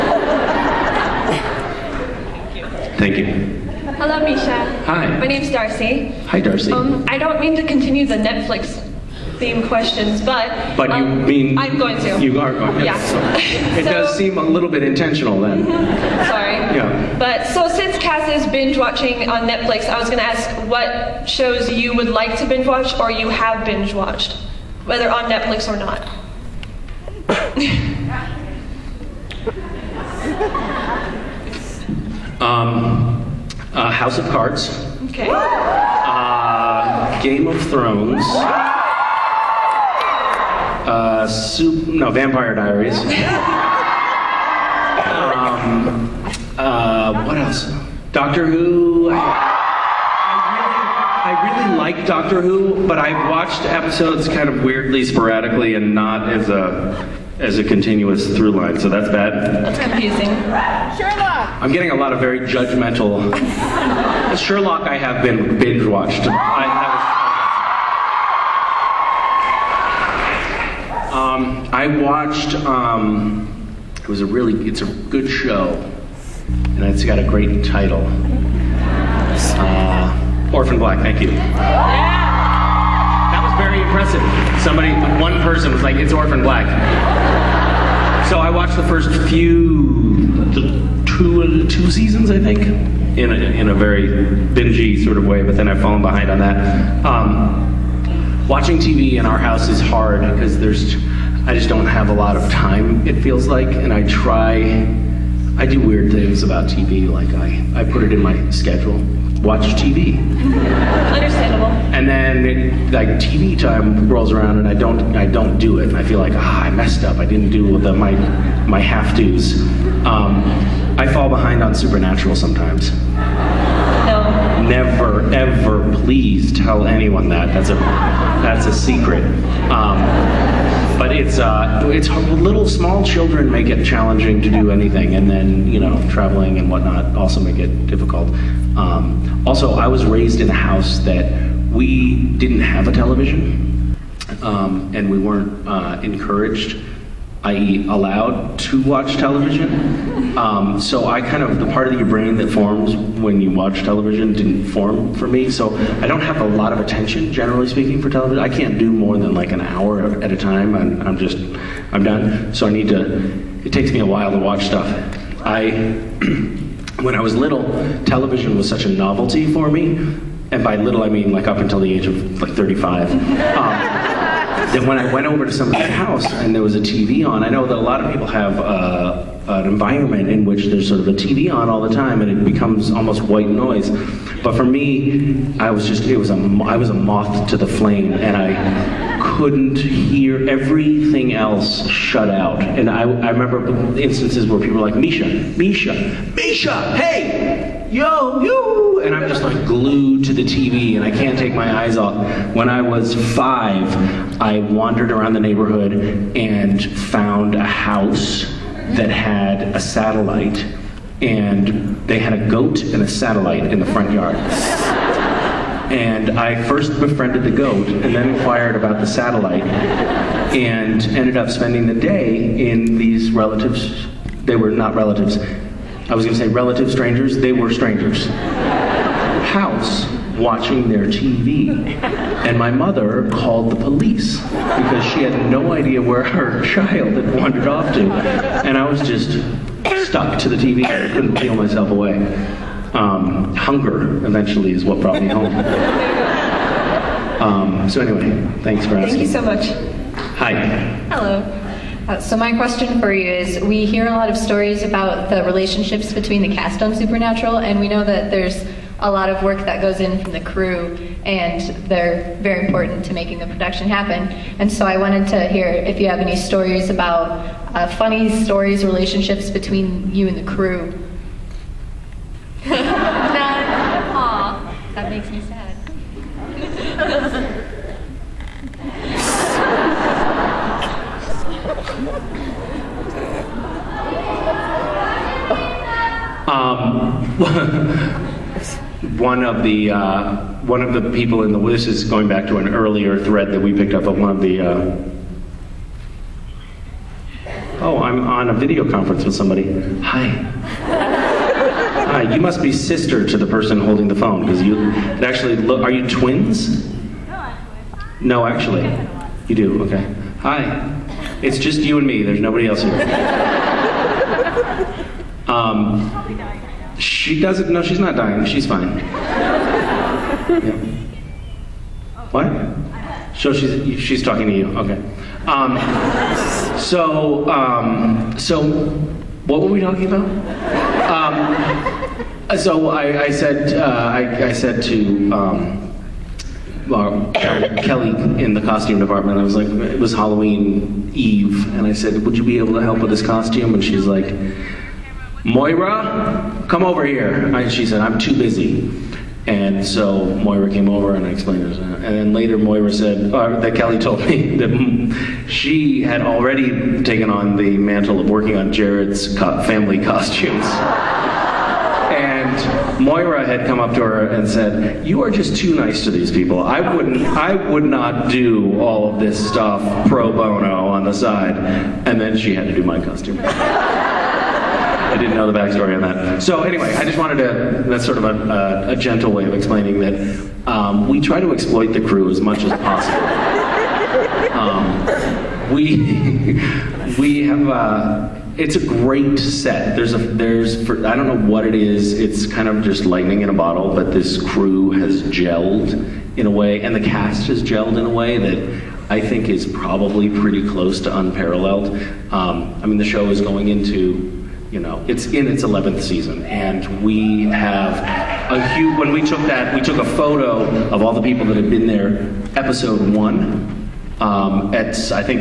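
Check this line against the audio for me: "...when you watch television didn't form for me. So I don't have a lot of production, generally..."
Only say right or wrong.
wrong.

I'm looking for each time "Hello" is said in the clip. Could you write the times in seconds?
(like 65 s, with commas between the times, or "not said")
3 s, 251 s.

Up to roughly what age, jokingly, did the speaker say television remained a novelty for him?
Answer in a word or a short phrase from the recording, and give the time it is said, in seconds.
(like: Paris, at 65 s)
35, at 172 s.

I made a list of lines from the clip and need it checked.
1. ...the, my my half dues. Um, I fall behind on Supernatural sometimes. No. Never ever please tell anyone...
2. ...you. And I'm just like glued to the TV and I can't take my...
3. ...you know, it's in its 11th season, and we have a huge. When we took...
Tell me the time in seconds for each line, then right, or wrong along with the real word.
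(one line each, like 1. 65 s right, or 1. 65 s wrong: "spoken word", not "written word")
1. 117 s right
2. 198 s right
3. 404 s right.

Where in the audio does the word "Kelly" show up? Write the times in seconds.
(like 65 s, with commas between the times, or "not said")
337 s, 353 s.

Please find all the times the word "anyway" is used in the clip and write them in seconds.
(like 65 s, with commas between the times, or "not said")
248 s, 376 s.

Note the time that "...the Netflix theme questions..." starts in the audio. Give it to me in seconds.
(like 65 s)
8 s.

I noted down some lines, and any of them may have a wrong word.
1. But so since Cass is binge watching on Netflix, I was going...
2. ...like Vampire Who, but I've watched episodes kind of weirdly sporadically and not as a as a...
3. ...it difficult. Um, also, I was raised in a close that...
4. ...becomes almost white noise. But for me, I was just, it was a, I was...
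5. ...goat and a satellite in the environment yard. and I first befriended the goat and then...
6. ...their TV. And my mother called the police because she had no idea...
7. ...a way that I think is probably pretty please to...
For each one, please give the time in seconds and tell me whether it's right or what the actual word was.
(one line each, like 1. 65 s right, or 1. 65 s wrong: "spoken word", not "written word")
1. 17 s right
2. 51 s wrong: "Doctor", not "Vampire"
3. 137 s wrong: "house", not "close"
4. 182 s right
5. 212 s wrong: "front", not "environment"
6. 230 s right
7. 398 s wrong: "close", not "please".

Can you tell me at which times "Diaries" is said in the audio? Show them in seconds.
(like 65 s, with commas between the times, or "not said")
42 s.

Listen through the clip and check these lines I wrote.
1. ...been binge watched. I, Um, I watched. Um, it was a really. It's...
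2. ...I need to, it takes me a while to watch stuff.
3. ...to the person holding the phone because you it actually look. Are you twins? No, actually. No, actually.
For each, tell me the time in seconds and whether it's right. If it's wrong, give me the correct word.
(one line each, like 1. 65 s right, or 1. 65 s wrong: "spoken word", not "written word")
1. 65 s right
2. 162 s right
3. 303 s right.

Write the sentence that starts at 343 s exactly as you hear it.
And she's like, Moira, come over here.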